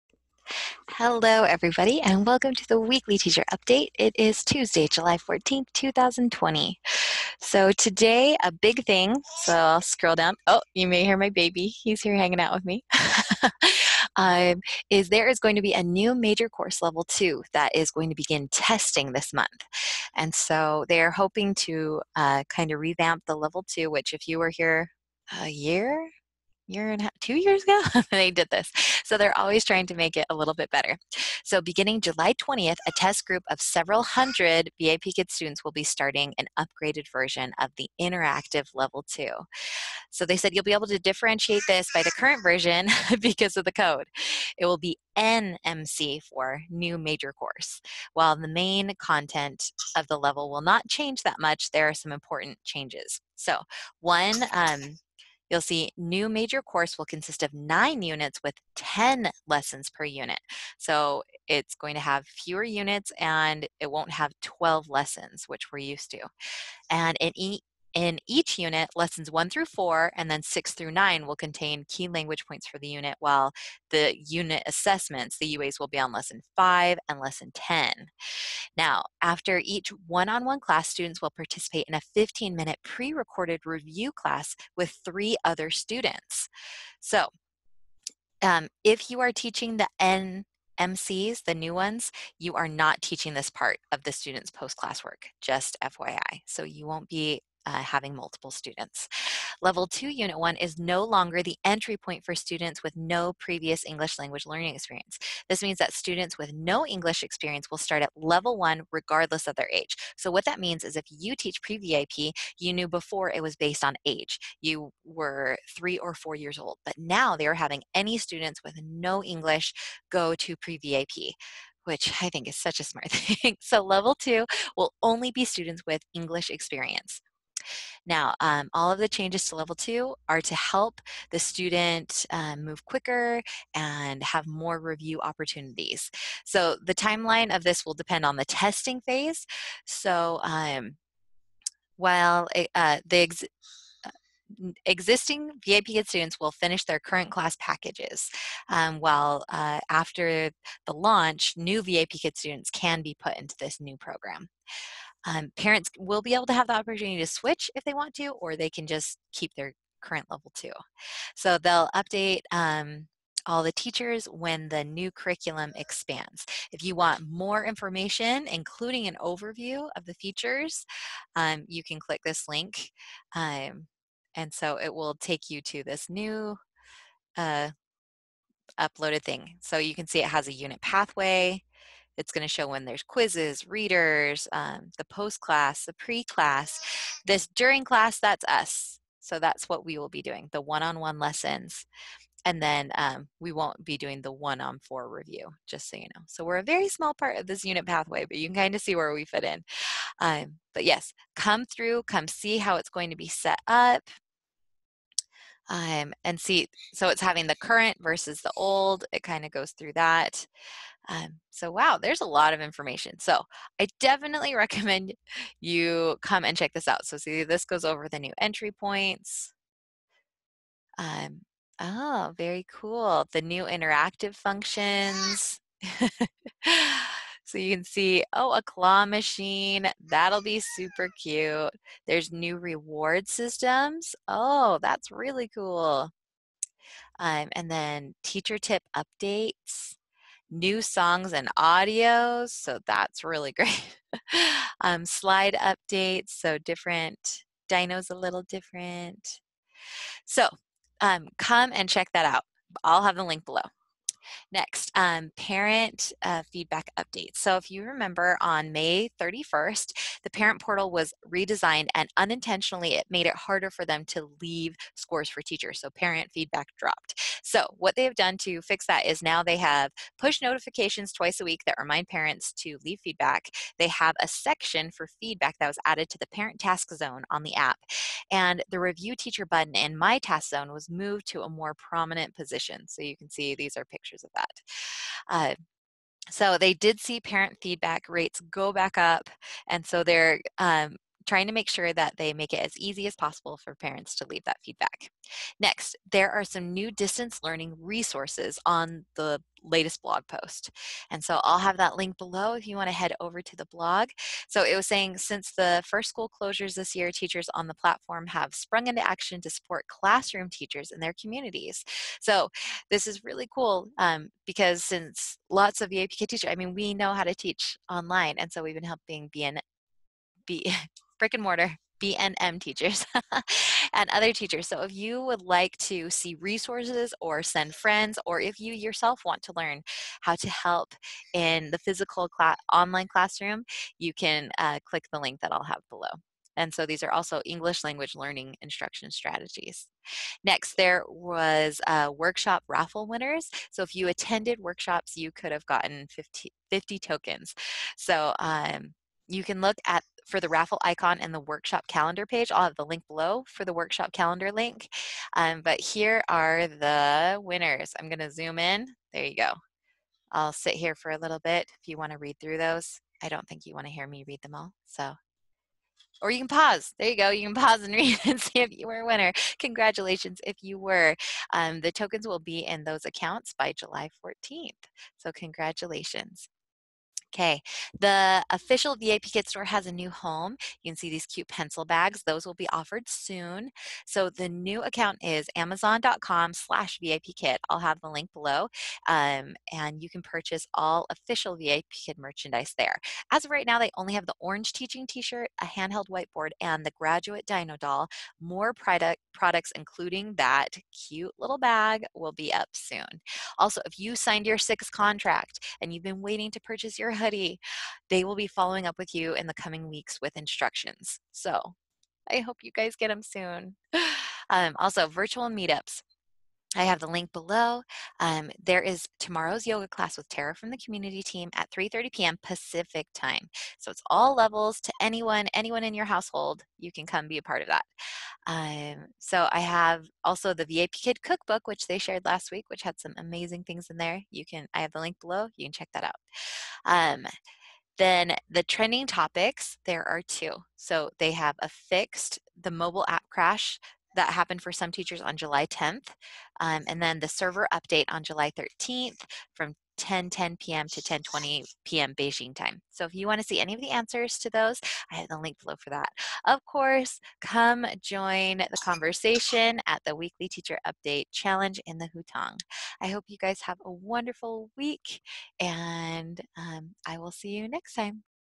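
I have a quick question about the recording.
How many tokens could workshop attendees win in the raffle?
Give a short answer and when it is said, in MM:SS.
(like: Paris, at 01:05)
50, at 05:46.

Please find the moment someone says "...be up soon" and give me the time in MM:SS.
06:42.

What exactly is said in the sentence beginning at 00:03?
It is Tuesday, July 14th, 2020.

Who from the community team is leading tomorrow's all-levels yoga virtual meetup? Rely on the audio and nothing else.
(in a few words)
Tara.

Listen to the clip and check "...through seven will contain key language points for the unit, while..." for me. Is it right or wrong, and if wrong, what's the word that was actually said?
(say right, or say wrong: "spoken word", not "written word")
wrong: "nine", not "seven".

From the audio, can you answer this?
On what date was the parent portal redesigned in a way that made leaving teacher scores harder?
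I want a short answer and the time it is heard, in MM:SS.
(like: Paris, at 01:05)
May 31st, at 04:18.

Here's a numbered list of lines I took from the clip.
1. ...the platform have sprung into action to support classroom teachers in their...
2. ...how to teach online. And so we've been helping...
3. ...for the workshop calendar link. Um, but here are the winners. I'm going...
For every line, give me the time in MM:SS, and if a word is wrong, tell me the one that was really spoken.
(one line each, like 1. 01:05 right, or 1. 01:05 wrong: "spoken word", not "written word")
1. 05:07 right
2. 05:17 right
3. 05:53 right.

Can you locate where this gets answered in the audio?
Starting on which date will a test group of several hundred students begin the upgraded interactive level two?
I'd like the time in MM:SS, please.
00:31.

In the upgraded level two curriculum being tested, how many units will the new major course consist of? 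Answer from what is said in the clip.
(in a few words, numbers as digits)
9.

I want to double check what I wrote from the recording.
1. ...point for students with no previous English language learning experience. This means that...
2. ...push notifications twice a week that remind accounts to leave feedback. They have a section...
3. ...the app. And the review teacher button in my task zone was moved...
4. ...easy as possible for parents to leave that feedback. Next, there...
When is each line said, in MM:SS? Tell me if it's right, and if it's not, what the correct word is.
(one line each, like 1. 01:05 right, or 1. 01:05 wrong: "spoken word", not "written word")
1. 01:41 right
2. 04:30 wrong: "parents", not "accounts"
3. 04:37 right
4. 04:52 right.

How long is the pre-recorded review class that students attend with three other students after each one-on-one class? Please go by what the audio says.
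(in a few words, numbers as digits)
15 minutes.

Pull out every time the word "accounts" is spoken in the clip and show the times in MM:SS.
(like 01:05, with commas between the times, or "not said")
06:13, 06:24.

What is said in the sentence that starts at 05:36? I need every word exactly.
And so these are also English language learning instruction strategies.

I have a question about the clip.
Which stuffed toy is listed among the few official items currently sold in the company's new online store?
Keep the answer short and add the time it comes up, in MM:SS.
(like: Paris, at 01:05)
graduate dino doll, at 06:36.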